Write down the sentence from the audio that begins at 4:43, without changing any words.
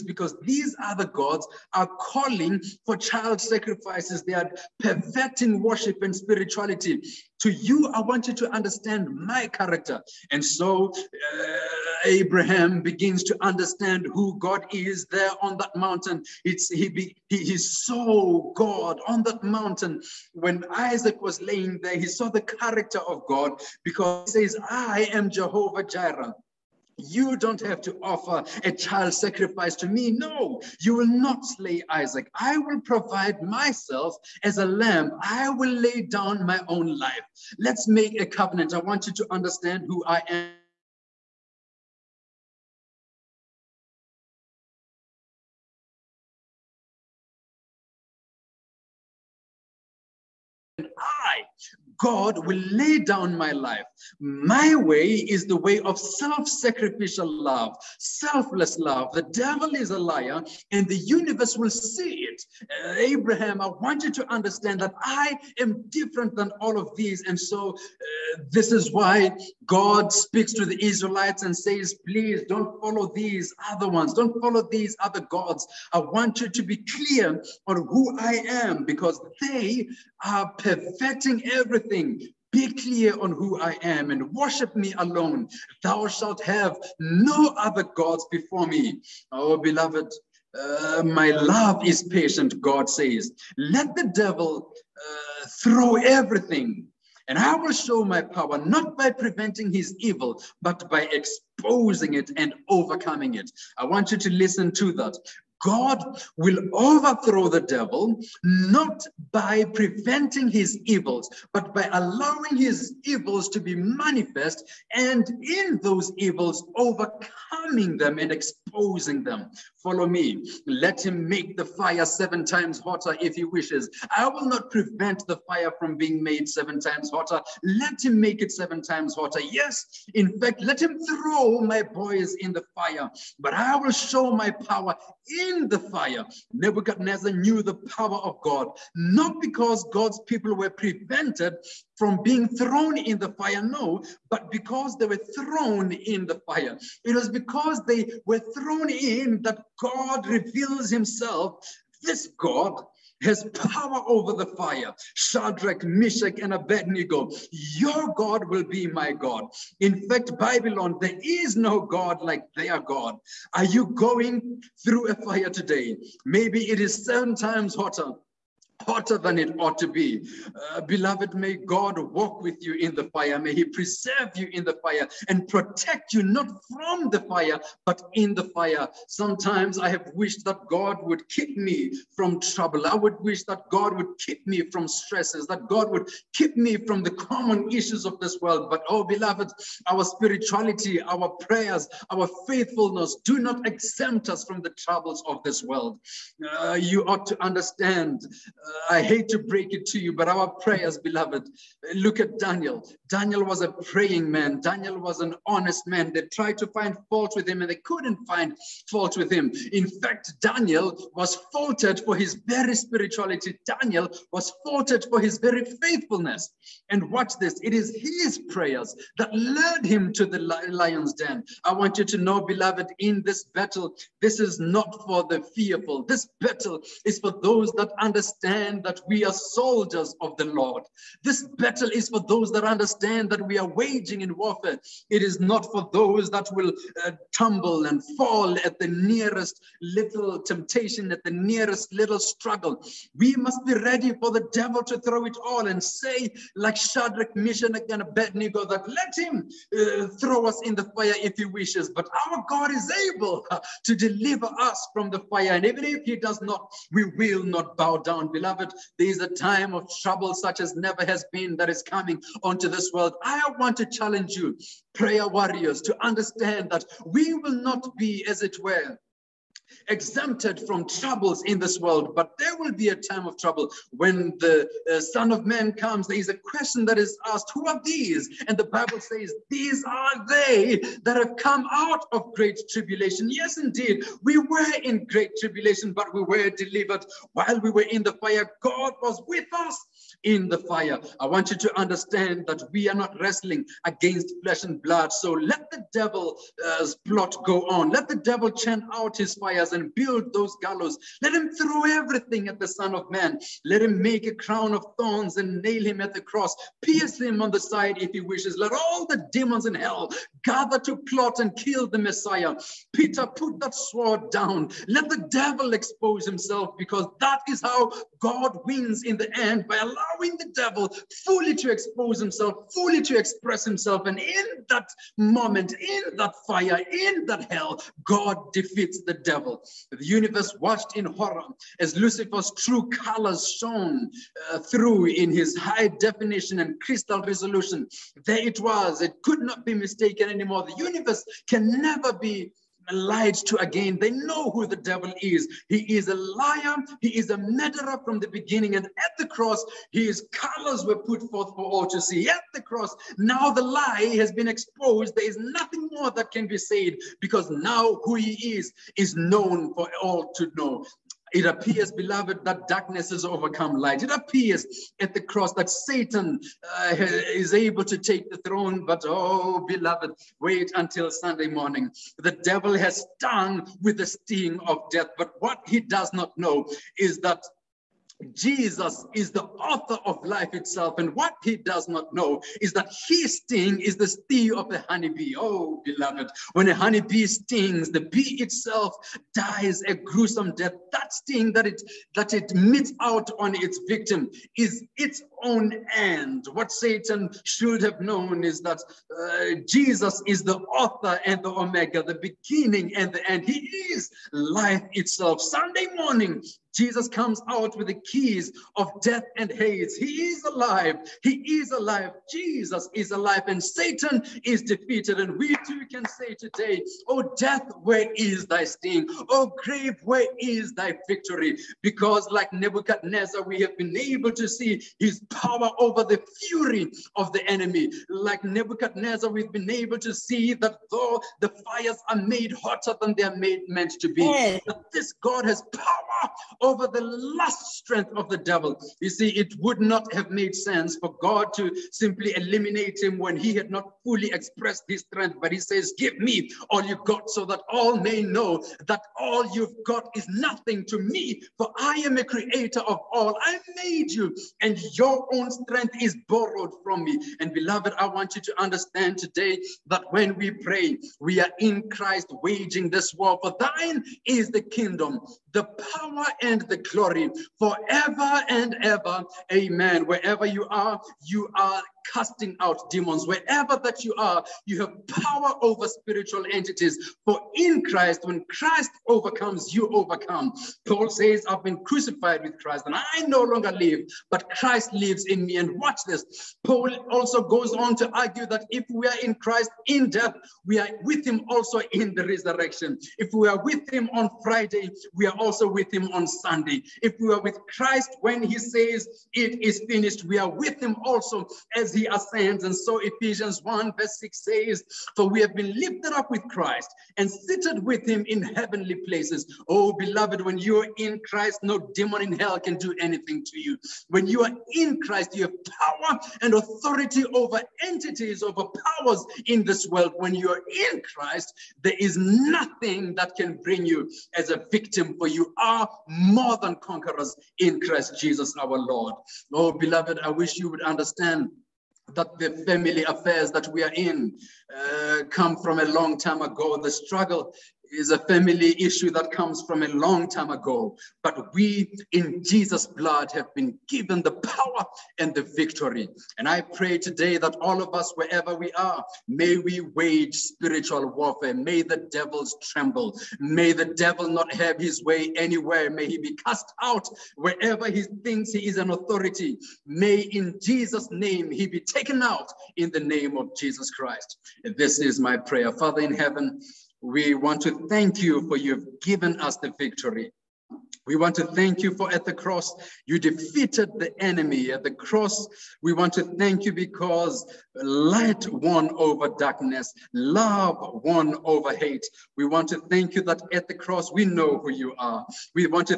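Yes, indeed, we were in great tribulation, but we were delivered.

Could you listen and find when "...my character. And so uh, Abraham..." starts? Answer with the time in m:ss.
0:09.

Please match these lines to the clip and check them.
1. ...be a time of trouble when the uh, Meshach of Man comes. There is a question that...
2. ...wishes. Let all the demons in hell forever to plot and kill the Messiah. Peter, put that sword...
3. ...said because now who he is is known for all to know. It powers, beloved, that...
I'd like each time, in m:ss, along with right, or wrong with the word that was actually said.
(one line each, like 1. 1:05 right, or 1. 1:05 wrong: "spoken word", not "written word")
1. 4:32 wrong: "Son", not "Meshach"
2. 5:08 wrong: "gather", not "forever"
3. 5:56 wrong: "appears", not "powers".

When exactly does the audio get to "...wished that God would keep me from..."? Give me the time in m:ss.
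3:00.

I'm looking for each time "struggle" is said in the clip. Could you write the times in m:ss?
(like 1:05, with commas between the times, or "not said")
4:02, 8:56.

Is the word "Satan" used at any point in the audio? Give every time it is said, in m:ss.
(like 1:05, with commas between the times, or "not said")
6:05, 6:36, 6:53.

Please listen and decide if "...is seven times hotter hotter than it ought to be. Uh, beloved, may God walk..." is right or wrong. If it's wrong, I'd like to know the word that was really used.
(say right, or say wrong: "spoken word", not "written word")
right.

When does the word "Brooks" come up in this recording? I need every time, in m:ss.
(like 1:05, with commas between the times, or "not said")
not said.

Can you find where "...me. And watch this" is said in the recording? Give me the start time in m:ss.
8:05.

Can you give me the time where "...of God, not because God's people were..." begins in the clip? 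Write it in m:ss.
2:18.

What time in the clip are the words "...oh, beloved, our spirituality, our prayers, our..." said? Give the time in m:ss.
3:08.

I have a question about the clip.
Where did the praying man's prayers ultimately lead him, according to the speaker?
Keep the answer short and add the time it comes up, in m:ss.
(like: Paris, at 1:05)
the lion's den, at 3:40.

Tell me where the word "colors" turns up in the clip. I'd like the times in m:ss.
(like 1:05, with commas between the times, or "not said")
5:32, 5:50.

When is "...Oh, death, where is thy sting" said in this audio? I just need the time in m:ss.
6:57.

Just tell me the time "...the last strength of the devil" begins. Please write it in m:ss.
7:16.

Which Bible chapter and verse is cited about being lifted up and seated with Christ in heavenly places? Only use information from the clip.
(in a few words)
Ephesians 1:6.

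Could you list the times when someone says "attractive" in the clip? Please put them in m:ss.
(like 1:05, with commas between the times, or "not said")
not said.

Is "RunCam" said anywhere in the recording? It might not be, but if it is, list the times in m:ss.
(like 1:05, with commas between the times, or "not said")
not said.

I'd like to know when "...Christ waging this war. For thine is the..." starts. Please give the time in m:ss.
7:41.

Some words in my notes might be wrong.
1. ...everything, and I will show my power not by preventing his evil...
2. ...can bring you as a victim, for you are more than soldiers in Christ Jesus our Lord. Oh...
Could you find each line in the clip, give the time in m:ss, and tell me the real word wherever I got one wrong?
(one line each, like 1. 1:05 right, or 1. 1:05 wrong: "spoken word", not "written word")
1. 1:35 right
2. 8:43 wrong: "conquerors", not "soldiers".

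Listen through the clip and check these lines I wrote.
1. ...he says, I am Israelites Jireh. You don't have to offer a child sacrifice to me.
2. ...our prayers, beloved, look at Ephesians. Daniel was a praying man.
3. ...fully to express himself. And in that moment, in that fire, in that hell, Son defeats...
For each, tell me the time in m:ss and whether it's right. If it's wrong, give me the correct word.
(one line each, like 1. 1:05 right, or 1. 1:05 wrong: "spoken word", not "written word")
1. 0:24 wrong: "Jehovah", not "Israelites"
2. 3:20 wrong: "Daniel", not "Ephesians"
3. 5:22 wrong: "God", not "Son".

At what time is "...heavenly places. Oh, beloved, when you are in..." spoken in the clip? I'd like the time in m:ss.
8:28.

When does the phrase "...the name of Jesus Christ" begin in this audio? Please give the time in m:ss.
9:22.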